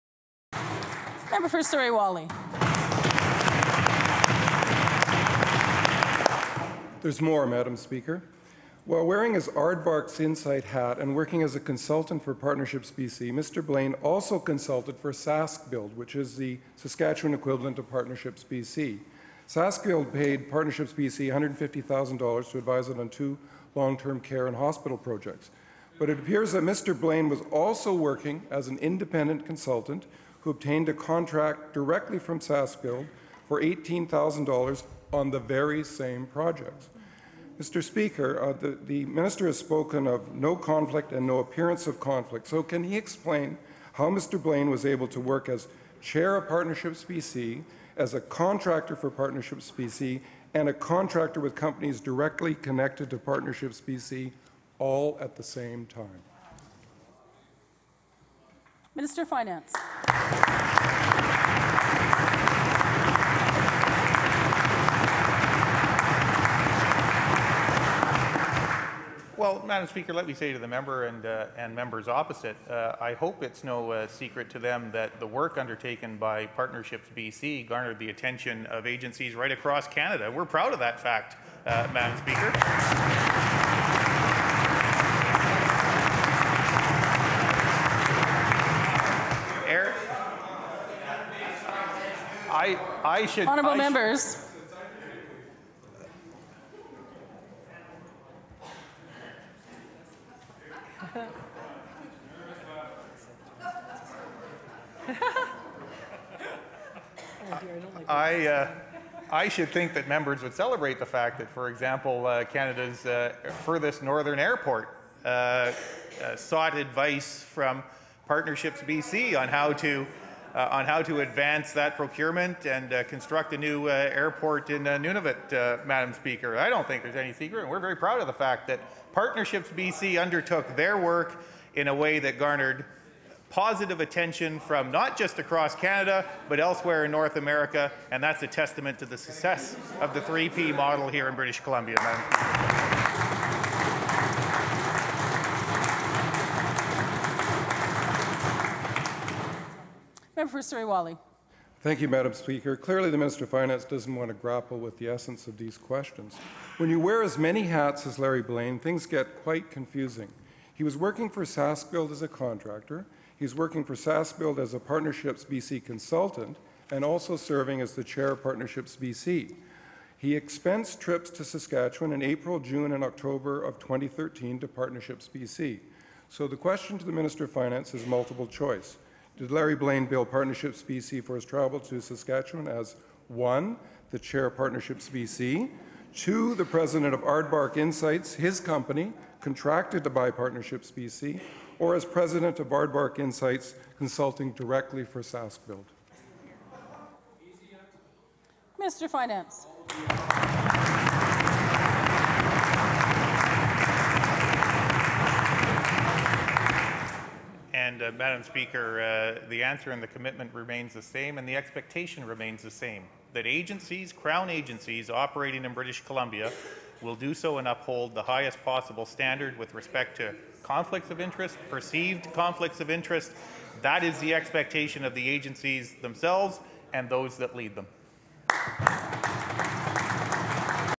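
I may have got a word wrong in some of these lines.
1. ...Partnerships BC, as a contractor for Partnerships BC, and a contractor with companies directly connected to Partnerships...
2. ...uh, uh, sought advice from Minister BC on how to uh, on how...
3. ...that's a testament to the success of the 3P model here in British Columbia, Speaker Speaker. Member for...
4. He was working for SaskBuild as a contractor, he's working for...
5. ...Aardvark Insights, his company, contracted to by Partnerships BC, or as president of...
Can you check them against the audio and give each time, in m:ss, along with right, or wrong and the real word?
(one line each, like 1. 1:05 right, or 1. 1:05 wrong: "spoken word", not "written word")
1. 0:46 right
2. 1:55 wrong: "Partnerships", not "Minister"
3. 2:18 wrong: "Madam", not "Speaker"
4. 2:40 right
5. 3:07 right.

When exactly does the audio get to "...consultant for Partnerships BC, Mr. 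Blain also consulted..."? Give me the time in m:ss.
0:11.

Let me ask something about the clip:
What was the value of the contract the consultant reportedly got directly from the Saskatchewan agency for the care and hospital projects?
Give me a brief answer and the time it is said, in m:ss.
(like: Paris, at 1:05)
$18,000, at 0:33.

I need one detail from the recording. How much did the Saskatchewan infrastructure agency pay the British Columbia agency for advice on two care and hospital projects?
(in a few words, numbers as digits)
$150,000.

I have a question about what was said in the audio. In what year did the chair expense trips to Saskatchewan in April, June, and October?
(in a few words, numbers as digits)
2013.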